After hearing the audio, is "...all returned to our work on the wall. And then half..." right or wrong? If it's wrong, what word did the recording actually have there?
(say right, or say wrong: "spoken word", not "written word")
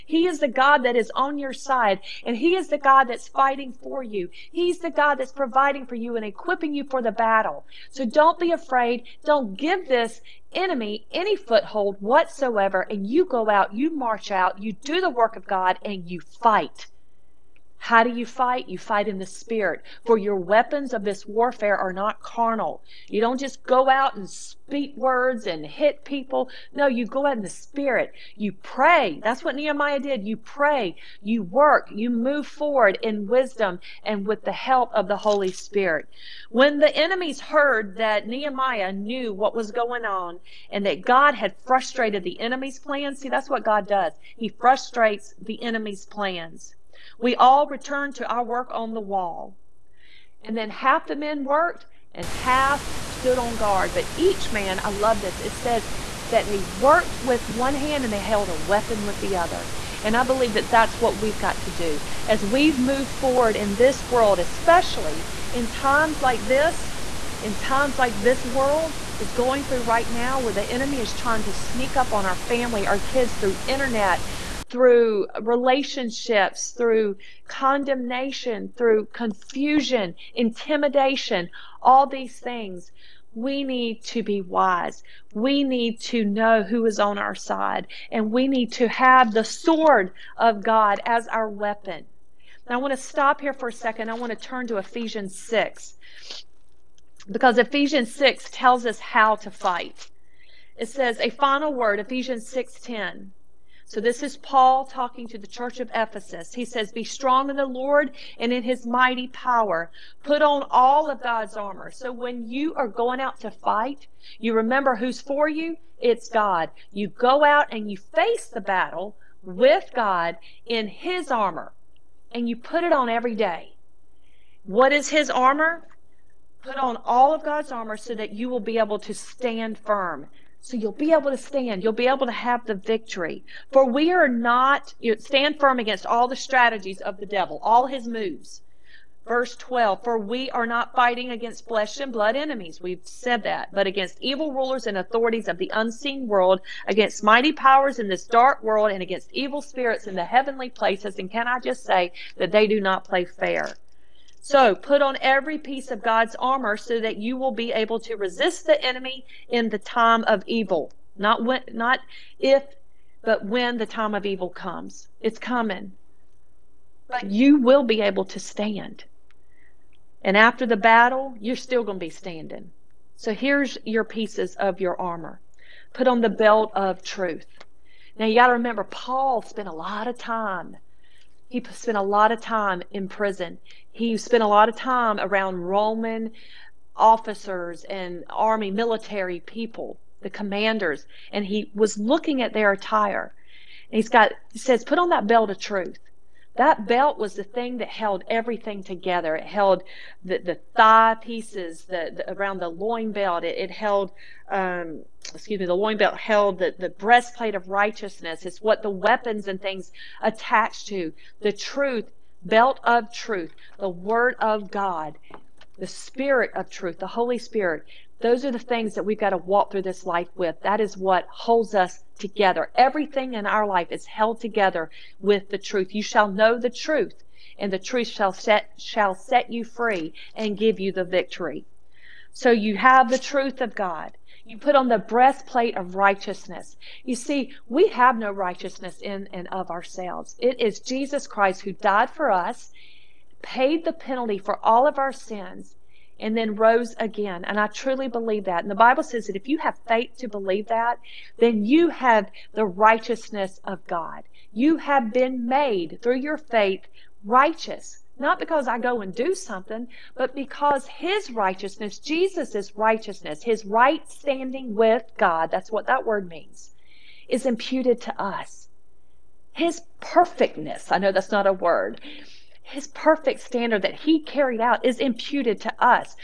right.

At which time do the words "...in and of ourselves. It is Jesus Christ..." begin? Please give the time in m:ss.
3:59.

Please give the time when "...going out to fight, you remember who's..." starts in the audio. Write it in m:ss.
1:52.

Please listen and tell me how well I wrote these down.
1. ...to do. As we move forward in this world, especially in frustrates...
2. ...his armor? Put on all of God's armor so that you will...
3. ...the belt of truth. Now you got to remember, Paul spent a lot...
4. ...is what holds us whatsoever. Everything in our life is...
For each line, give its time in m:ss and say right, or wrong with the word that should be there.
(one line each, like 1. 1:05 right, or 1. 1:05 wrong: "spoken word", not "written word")
1. 1:01 wrong: "times", not "frustrates"
2. 2:05 right
3. 2:56 right
4. 3:40 wrong: "together", not "whatsoever".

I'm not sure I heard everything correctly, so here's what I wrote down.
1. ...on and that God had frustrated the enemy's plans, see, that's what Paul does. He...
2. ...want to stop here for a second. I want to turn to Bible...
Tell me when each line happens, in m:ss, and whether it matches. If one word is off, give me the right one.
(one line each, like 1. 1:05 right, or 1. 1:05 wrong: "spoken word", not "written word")
1. 0:40 wrong: "God", not "Paul"
2. 1:32 wrong: "Ephesians", not "Bible".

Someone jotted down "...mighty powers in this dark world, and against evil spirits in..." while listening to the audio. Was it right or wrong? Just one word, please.
right.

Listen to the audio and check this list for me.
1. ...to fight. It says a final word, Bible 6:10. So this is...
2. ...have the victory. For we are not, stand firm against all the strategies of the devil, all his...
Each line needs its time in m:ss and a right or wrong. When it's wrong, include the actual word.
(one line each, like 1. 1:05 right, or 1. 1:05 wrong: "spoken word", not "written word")
1. 1:39 wrong: "Ephesians", not "Bible"
2. 2:12 right.